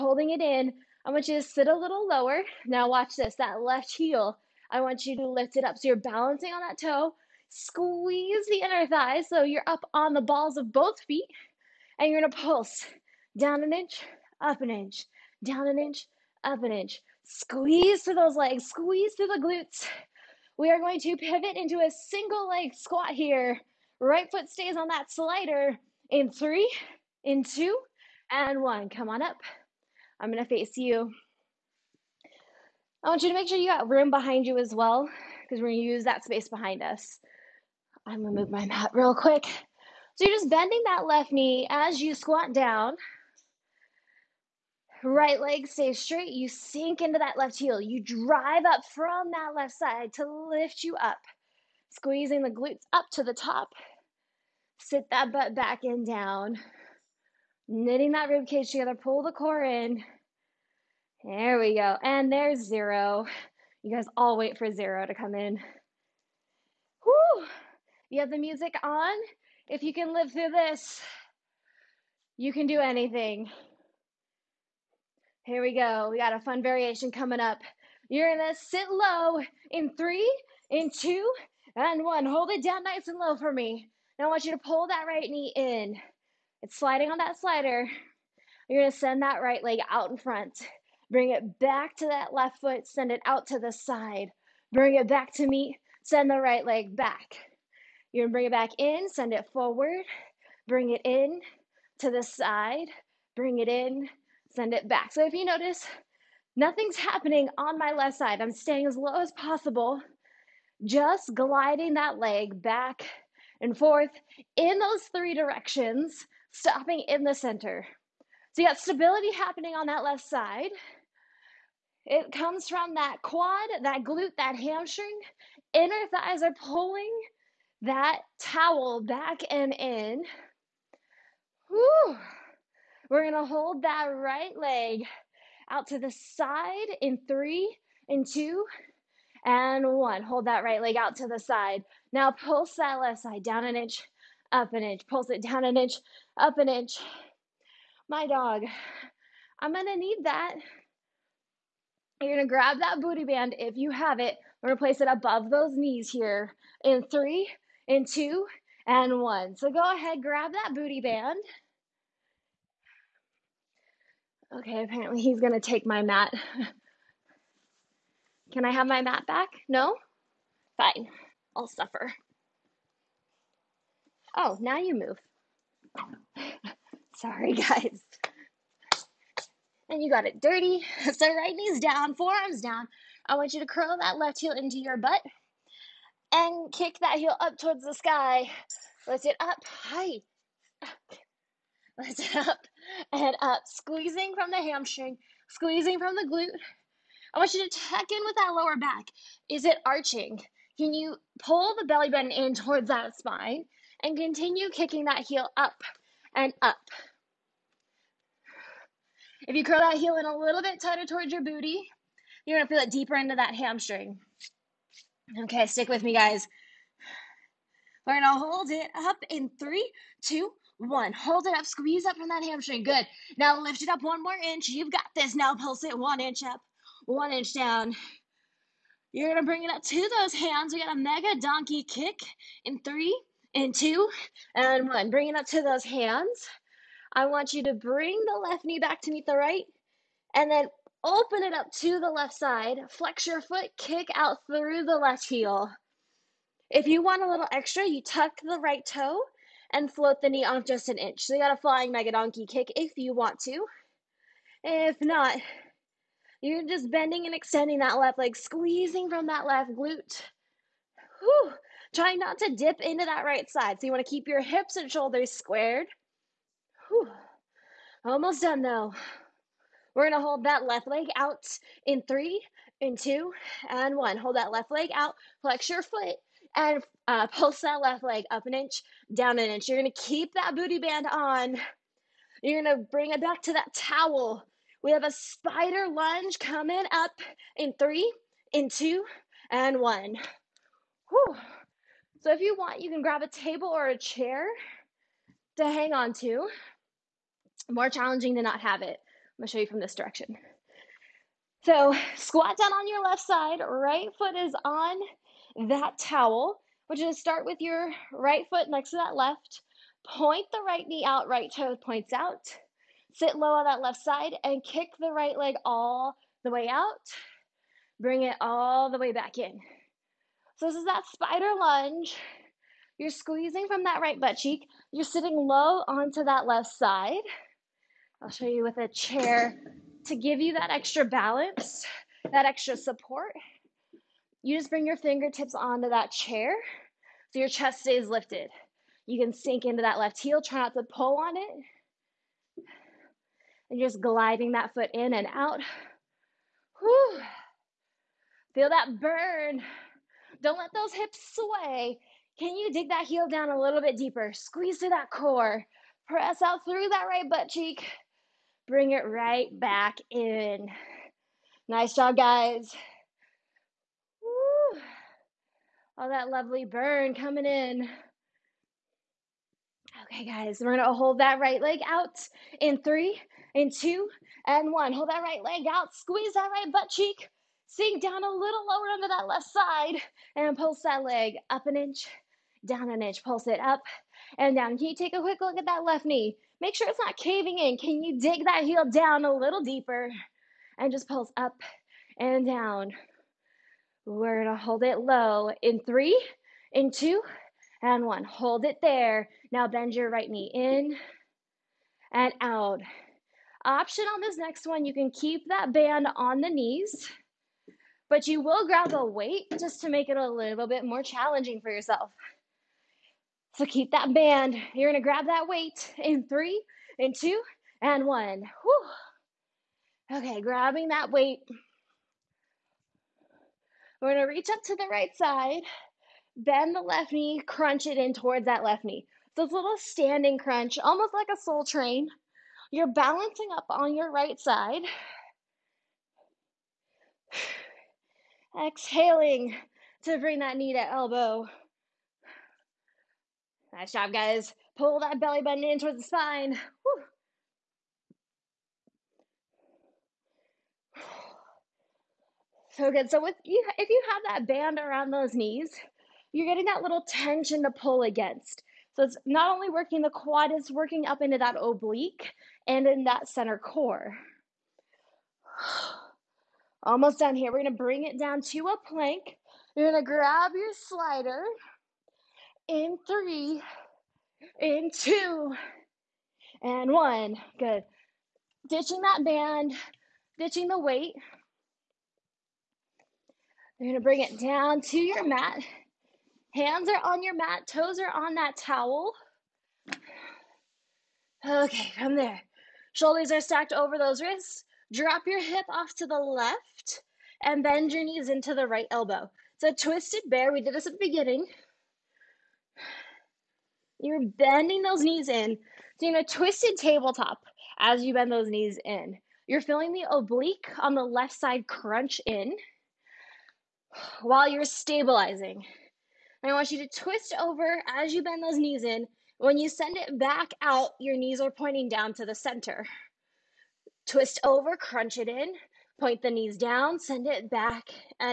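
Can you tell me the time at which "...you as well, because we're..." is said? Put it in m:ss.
0:34.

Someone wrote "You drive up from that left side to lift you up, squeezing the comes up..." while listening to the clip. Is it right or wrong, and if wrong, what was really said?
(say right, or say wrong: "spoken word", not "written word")
wrong: "glutes", not "comes".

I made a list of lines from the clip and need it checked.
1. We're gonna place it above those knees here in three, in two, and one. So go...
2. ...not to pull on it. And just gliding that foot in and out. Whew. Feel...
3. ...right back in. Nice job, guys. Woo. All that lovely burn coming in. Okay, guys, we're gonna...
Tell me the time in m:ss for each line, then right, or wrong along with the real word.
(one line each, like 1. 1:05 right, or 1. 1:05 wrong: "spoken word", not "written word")
1. 2:34 right
2. 5:40 right
3. 5:59 right.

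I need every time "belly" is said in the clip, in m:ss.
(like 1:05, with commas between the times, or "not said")
3:21, 7:25.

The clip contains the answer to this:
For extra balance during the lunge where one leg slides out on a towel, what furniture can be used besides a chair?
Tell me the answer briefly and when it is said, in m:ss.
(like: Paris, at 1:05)
table, at 4:53.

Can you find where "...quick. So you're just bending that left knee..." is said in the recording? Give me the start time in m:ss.
0:39.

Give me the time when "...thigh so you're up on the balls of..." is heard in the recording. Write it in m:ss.
0:08.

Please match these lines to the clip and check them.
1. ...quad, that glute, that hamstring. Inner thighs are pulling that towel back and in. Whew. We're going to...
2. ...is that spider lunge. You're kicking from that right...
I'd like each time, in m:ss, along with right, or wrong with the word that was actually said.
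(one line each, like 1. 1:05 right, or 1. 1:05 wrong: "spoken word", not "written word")
1. 2:03 right
2. 5:20 wrong: "squeezing", not "kicking".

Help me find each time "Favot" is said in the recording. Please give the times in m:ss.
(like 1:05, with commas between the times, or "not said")
not said.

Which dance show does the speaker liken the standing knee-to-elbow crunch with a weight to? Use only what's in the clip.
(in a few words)
Soul Train.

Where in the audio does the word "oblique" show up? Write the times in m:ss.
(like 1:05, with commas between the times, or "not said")
7:41, 8:30.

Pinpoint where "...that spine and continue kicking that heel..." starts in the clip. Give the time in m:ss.
3:22.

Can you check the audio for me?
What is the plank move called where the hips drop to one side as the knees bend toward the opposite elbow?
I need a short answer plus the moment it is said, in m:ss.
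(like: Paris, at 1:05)
twisted bear, at 8:19.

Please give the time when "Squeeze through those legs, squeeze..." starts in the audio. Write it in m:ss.
0:17.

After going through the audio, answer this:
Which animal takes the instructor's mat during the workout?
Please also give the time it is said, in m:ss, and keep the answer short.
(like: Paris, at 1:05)
dog, at 2:28.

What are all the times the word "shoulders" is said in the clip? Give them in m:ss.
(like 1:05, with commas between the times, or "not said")
4:24, 8:12.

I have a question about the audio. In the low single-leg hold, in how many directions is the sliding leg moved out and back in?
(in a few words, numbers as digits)
3.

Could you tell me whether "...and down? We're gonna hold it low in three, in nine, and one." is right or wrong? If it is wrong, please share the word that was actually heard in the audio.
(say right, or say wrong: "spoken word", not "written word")
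wrong: "two", not "nine".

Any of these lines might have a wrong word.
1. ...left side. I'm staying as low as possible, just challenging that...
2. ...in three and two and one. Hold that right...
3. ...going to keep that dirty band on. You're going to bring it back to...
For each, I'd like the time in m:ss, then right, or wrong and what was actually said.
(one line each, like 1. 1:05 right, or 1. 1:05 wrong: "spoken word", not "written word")
1. 1:47 wrong: "gliding", not "challenging"
2. 2:17 right
3. 4:39 wrong: "booty", not "dirty".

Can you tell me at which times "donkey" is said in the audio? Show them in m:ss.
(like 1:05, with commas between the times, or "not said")
3:51, 4:12.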